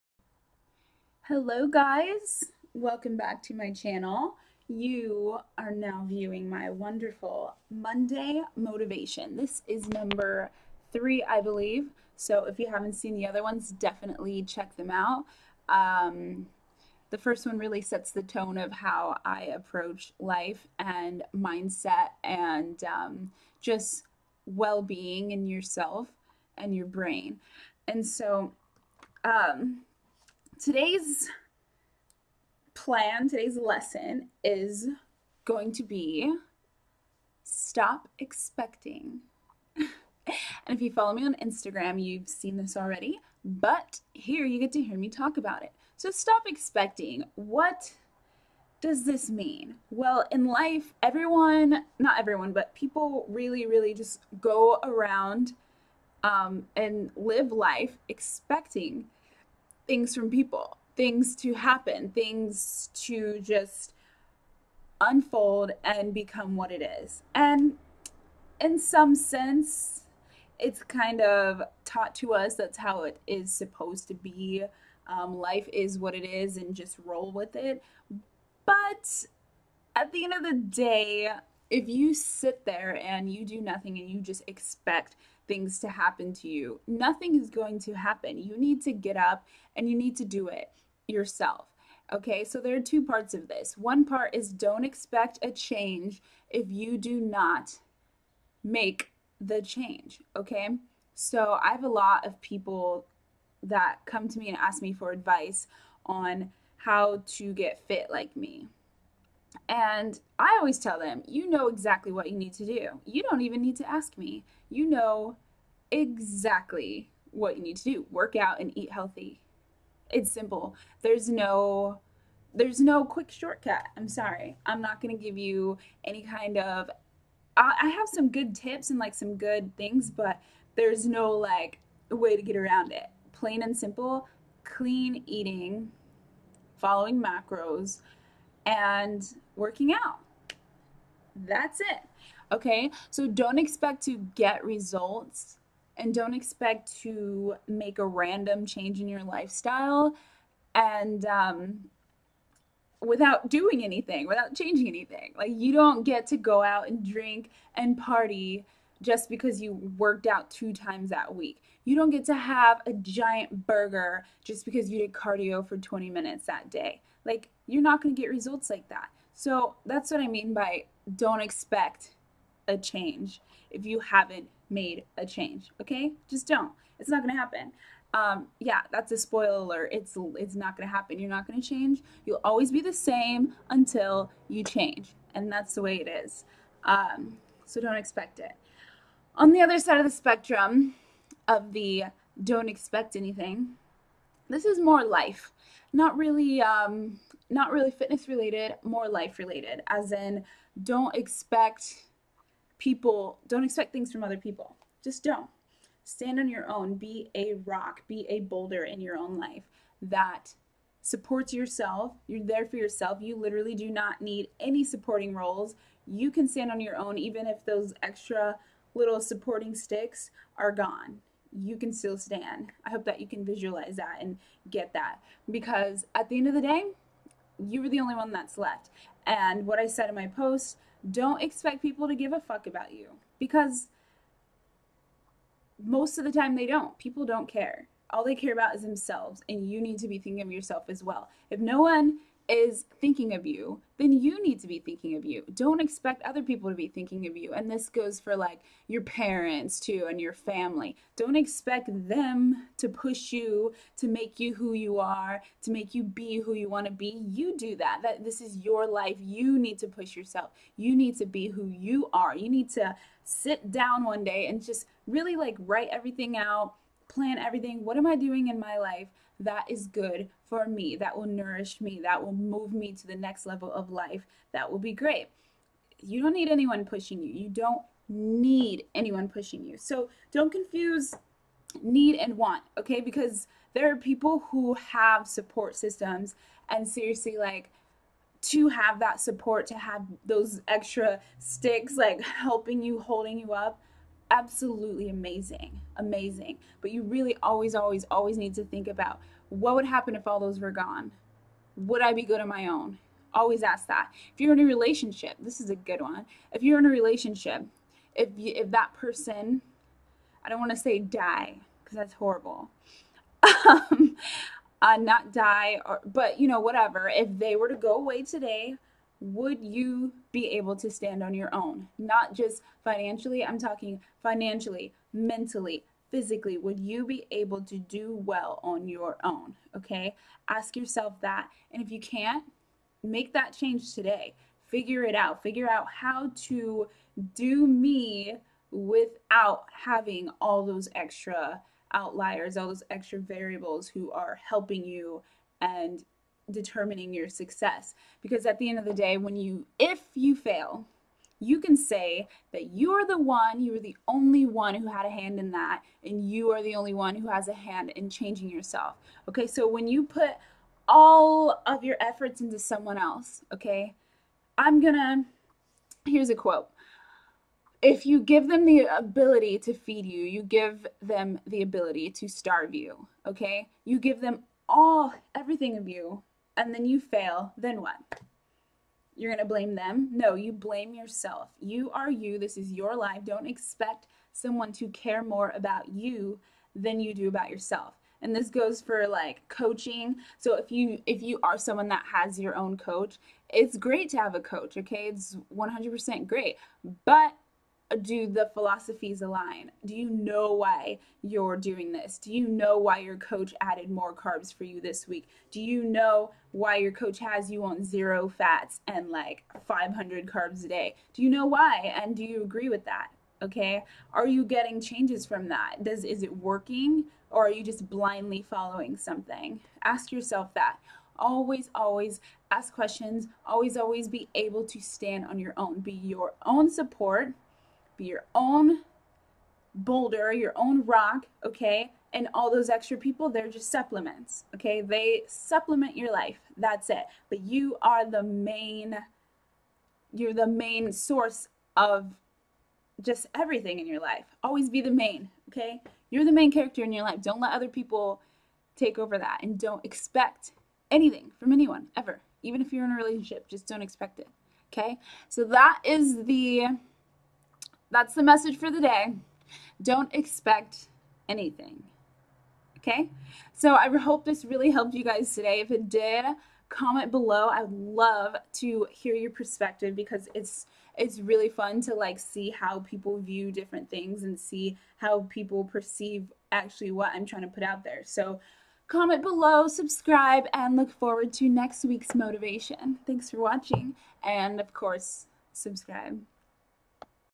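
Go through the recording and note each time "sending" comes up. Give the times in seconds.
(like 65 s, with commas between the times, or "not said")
not said.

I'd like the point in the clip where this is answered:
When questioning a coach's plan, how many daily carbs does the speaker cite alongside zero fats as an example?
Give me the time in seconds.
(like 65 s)
409 s.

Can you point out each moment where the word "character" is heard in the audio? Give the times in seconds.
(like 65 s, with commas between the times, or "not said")
446 s.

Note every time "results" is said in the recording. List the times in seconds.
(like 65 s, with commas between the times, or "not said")
144 s, 168 s.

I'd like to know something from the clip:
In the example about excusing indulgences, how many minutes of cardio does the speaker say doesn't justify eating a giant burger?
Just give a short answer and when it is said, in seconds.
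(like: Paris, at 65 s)
20 minutes, at 165 s.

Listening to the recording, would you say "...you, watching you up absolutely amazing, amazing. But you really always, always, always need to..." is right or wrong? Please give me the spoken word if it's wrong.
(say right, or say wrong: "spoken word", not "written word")
wrong: "holding", not "watching".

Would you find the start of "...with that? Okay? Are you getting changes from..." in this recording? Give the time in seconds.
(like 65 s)
412 s.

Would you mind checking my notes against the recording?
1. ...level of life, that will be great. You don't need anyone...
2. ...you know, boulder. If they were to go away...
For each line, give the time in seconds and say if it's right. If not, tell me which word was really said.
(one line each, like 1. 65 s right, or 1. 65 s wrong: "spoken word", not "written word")
1. 273 s right
2. 316 s wrong: "whatever", not "boulder".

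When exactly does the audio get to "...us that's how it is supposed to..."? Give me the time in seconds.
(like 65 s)
72 s.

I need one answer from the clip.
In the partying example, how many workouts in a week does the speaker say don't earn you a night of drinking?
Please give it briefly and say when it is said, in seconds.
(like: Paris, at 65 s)
2, at 160 s.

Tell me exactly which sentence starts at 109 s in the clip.
And I always tell them, you know exactly what you need to do.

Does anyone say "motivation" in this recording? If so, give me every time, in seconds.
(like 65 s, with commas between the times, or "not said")
8 s, 482 s.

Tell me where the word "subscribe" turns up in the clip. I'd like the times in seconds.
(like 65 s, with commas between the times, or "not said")
479 s, 485 s.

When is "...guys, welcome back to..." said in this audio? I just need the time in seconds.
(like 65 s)
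1 s.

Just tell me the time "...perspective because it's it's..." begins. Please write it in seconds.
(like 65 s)
469 s.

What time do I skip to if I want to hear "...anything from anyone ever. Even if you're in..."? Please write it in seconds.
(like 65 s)
450 s.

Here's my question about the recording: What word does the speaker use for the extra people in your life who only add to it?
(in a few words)
Supplements.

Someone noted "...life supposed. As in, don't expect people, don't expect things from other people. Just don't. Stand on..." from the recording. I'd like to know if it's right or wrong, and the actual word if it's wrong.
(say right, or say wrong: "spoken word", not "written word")
wrong: "related", not "supposed".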